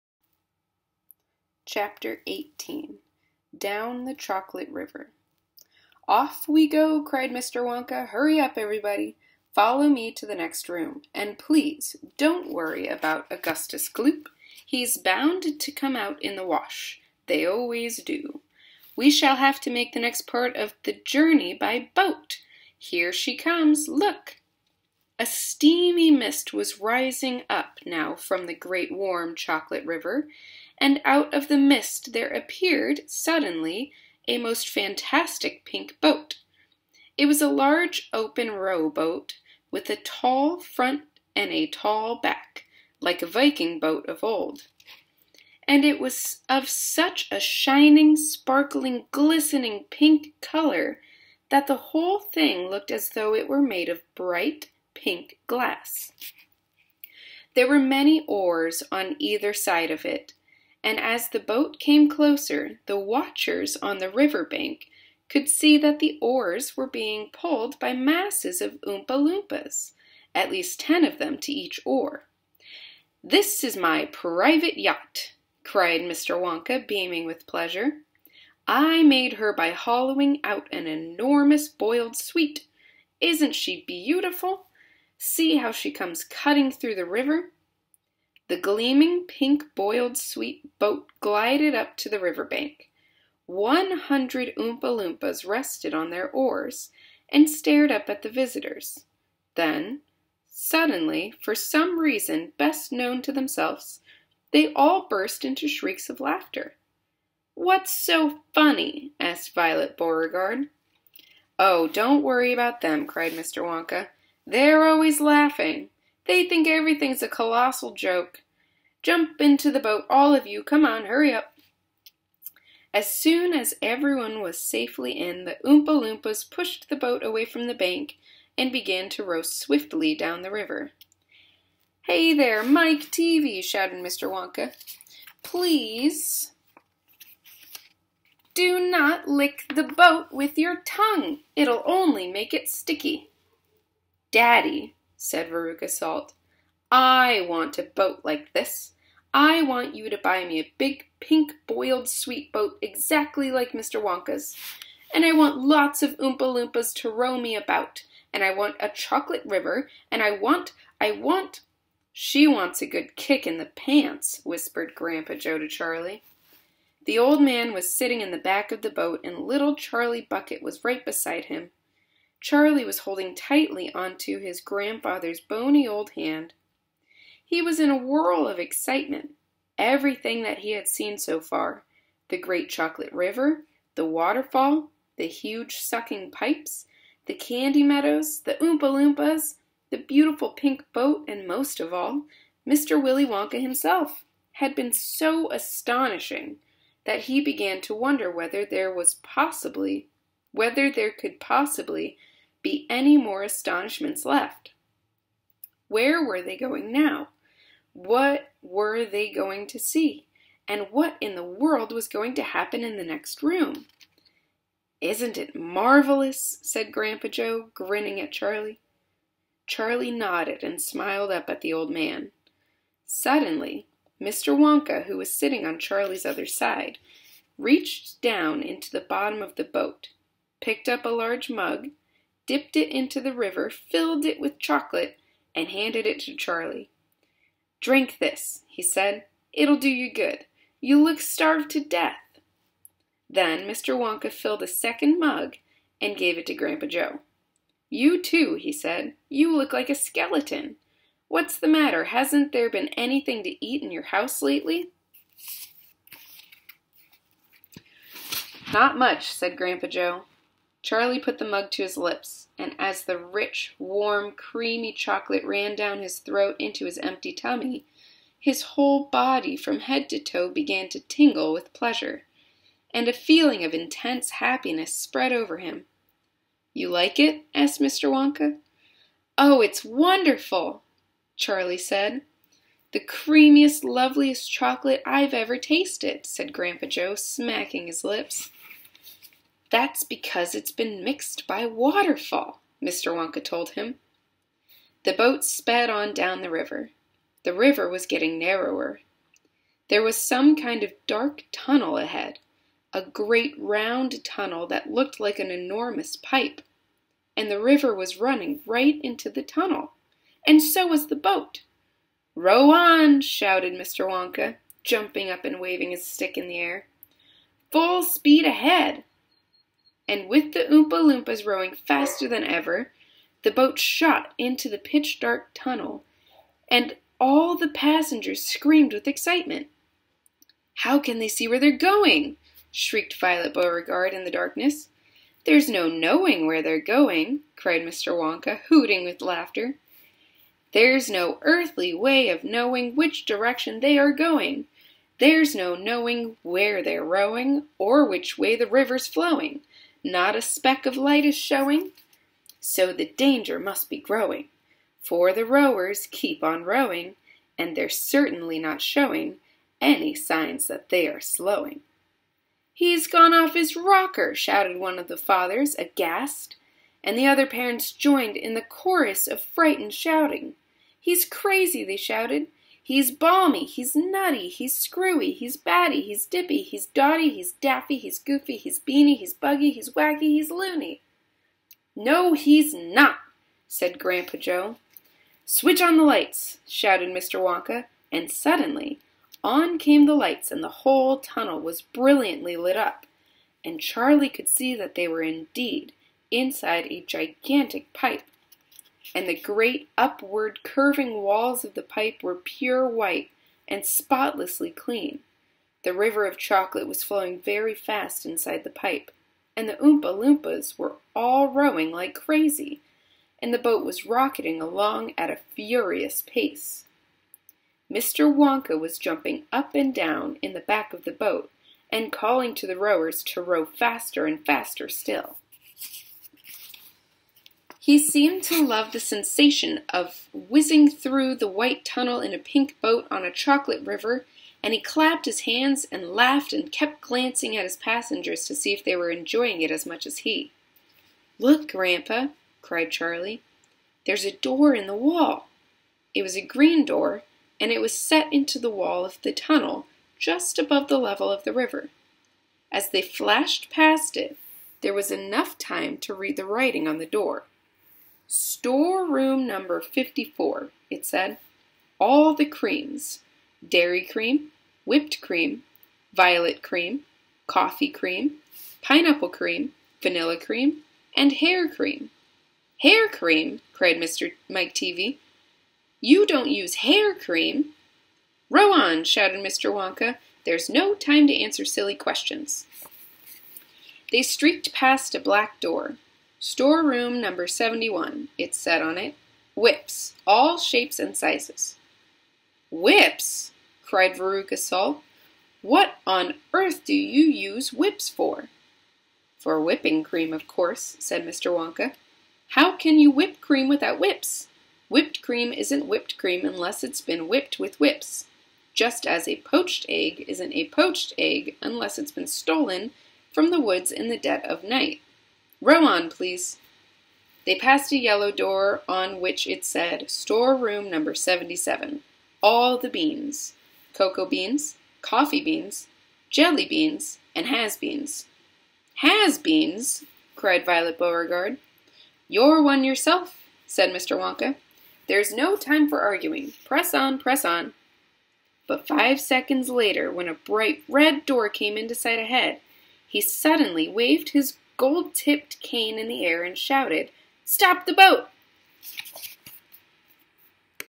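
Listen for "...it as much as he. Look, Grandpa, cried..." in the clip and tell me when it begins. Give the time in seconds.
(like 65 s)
439 s.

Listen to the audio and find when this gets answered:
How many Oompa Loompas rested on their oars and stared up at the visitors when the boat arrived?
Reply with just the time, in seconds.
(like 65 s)
93 s.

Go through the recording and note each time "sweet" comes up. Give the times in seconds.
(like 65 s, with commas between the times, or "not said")
82 s, 90 s, 152 s.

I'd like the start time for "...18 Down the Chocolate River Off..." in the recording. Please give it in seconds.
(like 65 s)
2 s.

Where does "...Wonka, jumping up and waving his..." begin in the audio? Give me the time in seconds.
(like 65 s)
314 s.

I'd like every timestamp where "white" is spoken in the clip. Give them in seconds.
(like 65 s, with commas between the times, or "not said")
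402 s, 431 s.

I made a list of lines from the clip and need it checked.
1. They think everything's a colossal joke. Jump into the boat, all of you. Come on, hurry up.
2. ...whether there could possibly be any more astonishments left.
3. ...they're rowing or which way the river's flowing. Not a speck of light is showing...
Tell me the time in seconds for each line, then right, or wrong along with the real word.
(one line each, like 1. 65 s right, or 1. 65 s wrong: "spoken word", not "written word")
1. 116 s right
2. 200 s right
3. 346 s right.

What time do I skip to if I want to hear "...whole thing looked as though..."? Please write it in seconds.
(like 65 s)
51 s.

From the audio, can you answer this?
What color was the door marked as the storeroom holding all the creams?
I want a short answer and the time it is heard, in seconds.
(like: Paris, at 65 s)
green, at 446 s.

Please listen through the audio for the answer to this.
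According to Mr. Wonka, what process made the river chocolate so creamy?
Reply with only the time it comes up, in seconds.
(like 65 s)
291 s.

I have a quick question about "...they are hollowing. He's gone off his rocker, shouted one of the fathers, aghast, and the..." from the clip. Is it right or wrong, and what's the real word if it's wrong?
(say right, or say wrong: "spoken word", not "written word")
wrong: "slowing", not "hollowing".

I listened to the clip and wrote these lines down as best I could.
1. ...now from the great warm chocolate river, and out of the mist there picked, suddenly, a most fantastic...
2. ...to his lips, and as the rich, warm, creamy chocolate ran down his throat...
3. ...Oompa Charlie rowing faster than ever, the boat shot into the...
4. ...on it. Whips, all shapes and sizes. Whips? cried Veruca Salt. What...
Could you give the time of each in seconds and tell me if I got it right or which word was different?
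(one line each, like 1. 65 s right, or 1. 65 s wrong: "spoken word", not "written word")
1. 27 s wrong: "appeared", not "picked"
2. 261 s right
3. 320 s wrong: "Loompas", not "Charlie"
4. 488 s right.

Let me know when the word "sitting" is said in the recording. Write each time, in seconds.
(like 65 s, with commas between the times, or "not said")
167 s, 225 s.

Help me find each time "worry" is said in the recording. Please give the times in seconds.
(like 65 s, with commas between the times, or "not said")
12 s, 112 s.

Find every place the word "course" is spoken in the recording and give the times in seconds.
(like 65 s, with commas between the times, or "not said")
500 s.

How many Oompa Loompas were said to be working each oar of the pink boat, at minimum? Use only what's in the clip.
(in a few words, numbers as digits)
at least 10.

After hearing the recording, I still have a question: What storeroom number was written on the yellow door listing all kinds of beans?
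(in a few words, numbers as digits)
77.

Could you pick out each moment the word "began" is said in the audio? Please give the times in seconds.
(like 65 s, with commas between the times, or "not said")
128 s, 197 s, 270 s.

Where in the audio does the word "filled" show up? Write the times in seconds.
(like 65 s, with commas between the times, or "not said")
233 s, 244 s.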